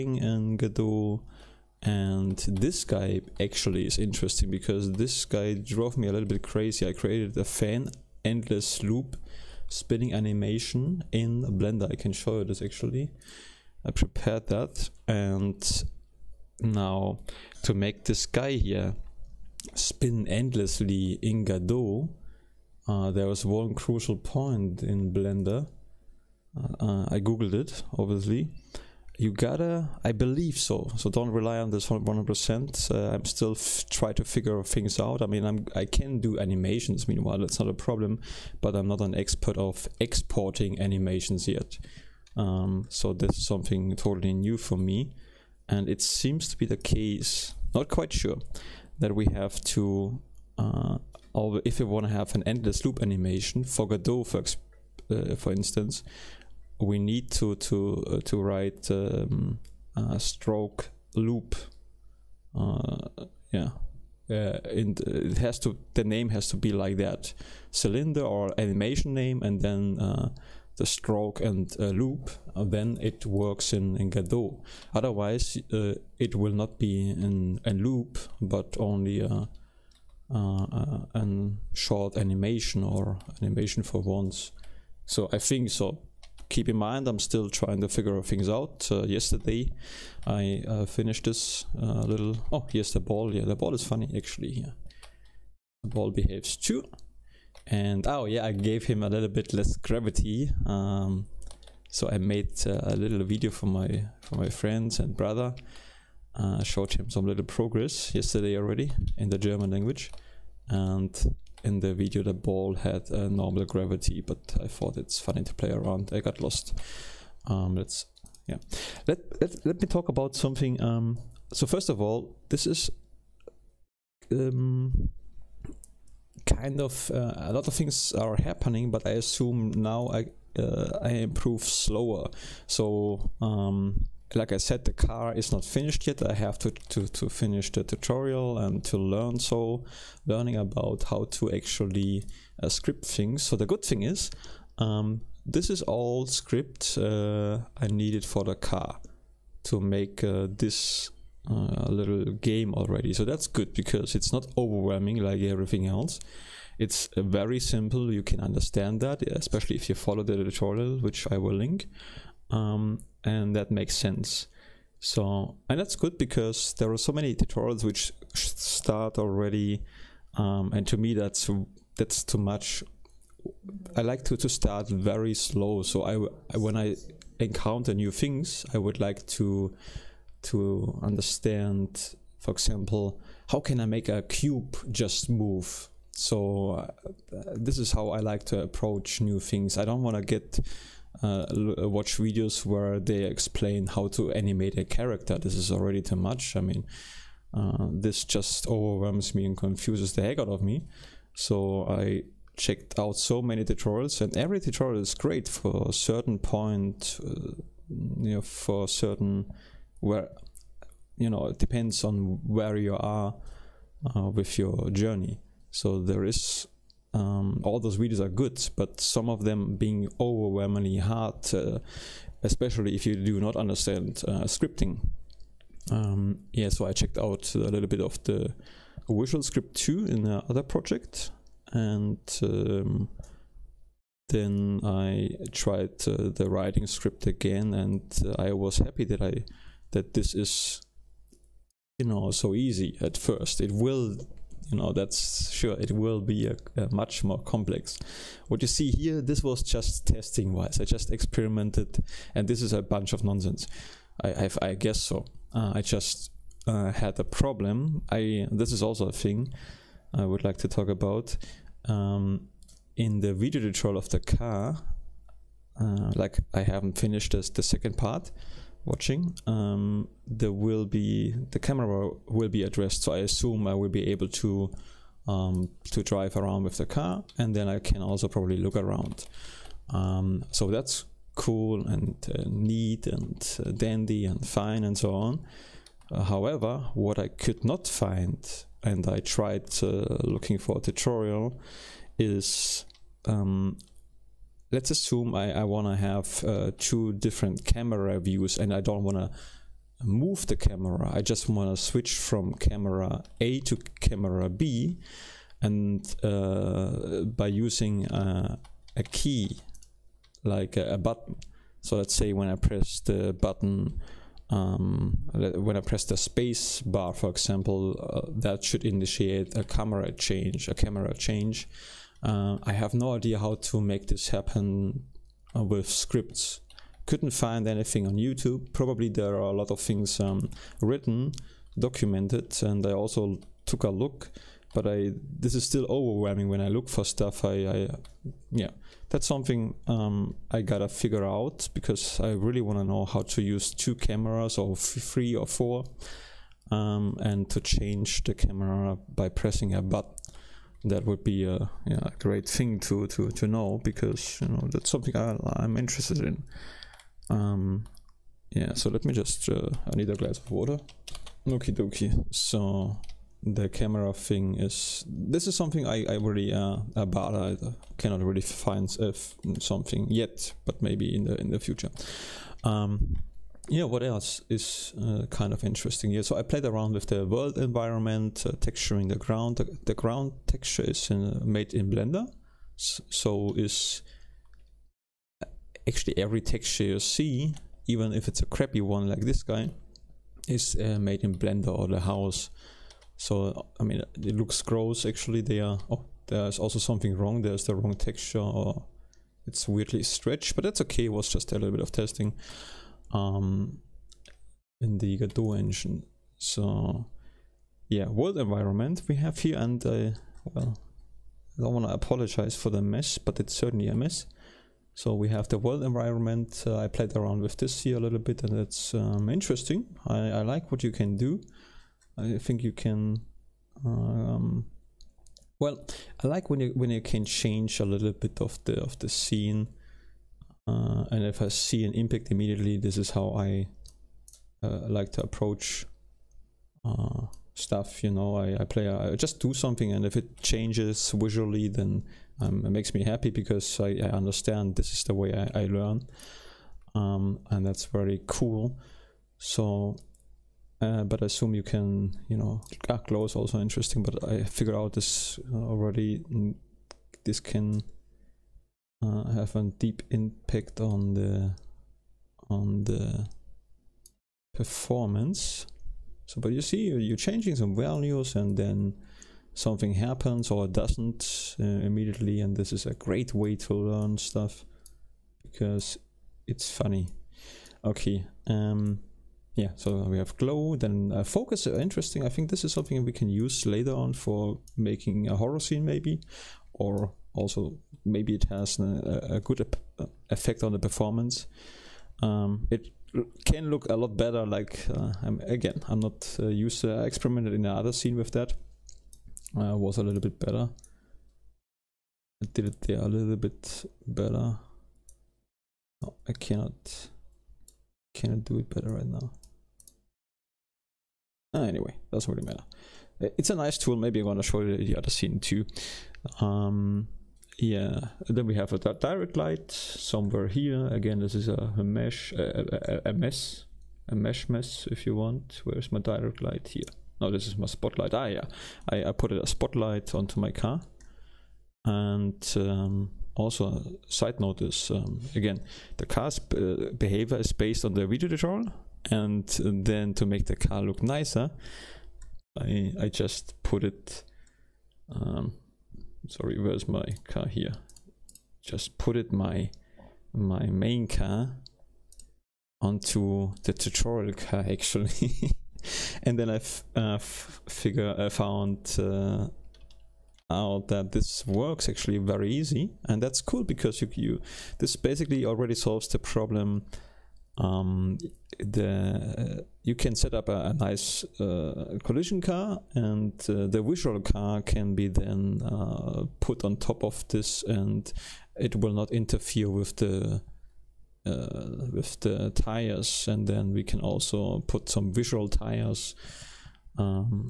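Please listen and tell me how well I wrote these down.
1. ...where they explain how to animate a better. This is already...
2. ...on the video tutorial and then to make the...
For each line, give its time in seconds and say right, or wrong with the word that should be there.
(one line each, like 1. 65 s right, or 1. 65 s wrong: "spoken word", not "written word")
1. 192 s wrong: "character", not "better"
2. 537 s right.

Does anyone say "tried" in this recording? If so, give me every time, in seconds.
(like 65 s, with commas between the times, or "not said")
235 s, 289 s.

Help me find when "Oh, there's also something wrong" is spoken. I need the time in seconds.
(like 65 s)
395 s.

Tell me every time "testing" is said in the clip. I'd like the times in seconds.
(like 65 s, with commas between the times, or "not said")
250 s, 401 s.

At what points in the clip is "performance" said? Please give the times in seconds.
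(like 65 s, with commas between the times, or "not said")
464 s, 490 s.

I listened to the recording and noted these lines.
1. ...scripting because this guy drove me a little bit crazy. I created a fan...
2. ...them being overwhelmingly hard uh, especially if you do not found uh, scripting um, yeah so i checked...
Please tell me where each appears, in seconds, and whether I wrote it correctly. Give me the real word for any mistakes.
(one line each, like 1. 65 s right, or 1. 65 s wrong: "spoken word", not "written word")
1. 3 s wrong: "interesting", not "scripting"
2. 219 s wrong: "understand", not "found".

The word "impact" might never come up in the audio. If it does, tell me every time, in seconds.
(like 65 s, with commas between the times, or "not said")
431 s, 460 s.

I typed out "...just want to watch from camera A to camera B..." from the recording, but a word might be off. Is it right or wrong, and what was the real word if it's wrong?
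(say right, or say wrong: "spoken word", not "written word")
wrong: "switch", not "watch".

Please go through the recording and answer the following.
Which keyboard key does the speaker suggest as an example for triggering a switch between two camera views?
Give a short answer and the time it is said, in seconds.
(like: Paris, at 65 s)
space bar, at 316 s.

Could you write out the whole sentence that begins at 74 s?
Otherwise uh, it will not be in a loop but only a, a, a, short animation or animation for once.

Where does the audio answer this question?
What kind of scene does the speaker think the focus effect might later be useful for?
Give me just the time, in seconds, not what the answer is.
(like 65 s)
485 s.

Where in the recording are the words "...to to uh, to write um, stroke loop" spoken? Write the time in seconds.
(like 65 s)
57 s.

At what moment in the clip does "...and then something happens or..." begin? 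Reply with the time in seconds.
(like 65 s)
468 s.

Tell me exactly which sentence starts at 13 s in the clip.
I prepared that and now to make this guy here spin endlessly in Godot, uh, there was one crucial point in Blender.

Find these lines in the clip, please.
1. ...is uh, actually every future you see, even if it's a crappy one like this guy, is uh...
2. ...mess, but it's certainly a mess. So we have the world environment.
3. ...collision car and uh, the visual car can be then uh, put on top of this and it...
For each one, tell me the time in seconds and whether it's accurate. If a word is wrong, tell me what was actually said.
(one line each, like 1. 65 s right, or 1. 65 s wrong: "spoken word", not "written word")
1. 383 s wrong: "texture", not "future"
2. 412 s right
3. 572 s right.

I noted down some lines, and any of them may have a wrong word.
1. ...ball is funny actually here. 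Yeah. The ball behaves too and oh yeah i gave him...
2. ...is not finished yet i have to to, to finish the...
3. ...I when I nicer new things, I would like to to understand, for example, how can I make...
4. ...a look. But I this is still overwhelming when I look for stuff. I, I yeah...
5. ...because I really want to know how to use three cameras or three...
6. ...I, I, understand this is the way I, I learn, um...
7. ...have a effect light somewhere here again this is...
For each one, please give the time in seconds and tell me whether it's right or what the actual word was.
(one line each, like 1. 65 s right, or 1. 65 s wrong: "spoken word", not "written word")
1. 93 s right
2. 135 s right
3. 176 s wrong: "encounter", not "nicer"
4. 333 s right
5. 341 s wrong: "two", not "three"
6. 443 s right
7. 518 s wrong: "direct", not "effect".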